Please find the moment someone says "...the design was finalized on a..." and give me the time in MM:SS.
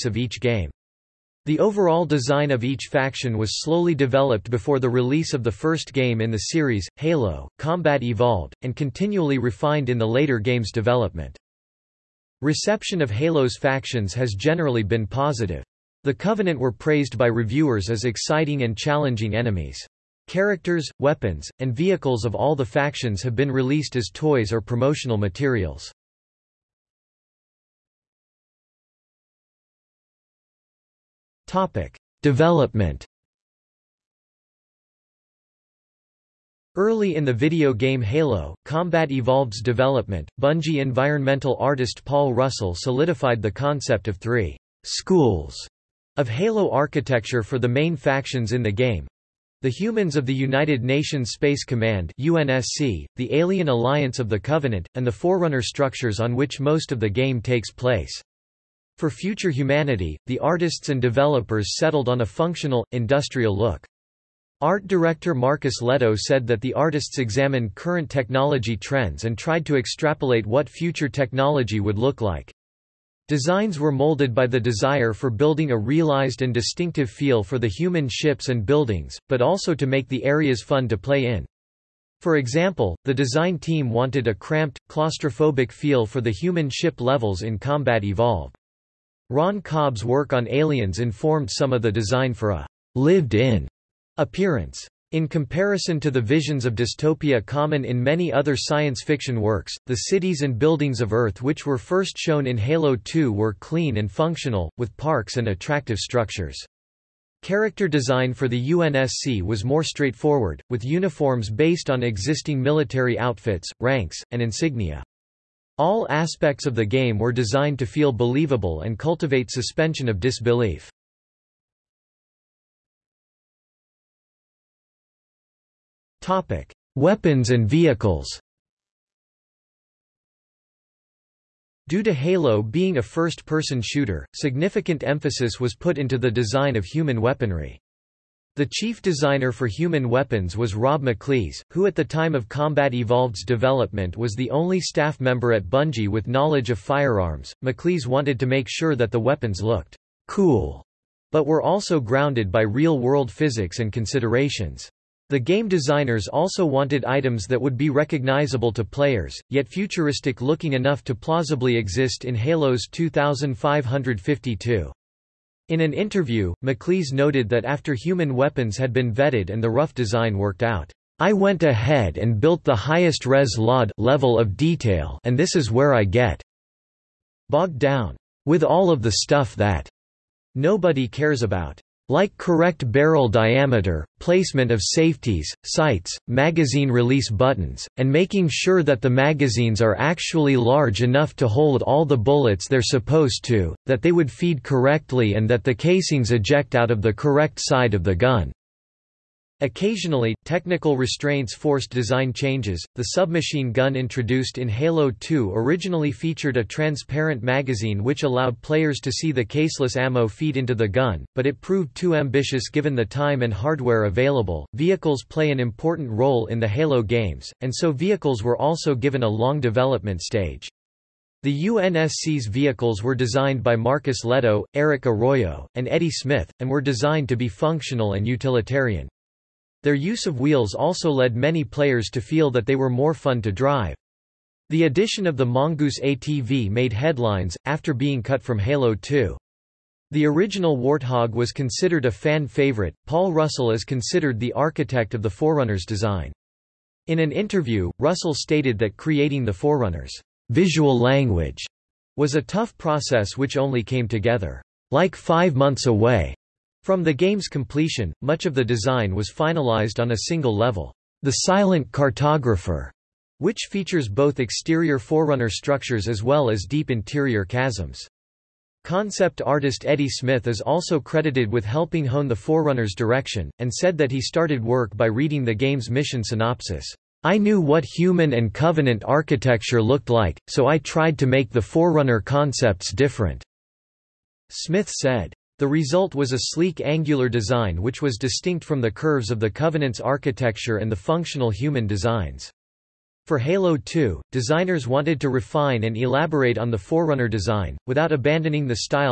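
04:18.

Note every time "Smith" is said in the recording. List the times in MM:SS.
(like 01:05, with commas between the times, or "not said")
03:46, 04:30, 04:44.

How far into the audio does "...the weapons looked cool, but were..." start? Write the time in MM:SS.
02:29.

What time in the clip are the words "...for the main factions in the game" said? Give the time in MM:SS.
00:47.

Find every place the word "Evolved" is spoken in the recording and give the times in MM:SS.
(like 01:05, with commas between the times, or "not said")
00:08, 00:39, 01:28, 02:22.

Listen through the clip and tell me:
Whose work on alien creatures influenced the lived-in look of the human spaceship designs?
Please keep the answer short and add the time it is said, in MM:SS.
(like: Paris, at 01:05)
Ron Cobb, at 01:29.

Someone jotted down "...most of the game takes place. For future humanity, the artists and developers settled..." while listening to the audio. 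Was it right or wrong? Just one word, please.
right.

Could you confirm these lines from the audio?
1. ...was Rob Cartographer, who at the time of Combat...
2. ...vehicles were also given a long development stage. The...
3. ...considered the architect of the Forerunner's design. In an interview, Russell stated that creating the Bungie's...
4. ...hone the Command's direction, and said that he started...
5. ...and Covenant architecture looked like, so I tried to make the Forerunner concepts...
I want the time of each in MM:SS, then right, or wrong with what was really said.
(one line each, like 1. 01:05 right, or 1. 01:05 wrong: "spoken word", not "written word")
1. 02:20 wrong: "McLees", not "Cartographer"
2. 03:37 right
3. 04:03 wrong: "Forerunner", not "Bungie"
4. 04:32 wrong: "Forerunner", not "Command"
5. 04:38 right.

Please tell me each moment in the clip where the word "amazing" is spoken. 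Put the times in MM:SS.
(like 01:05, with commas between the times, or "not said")
not said.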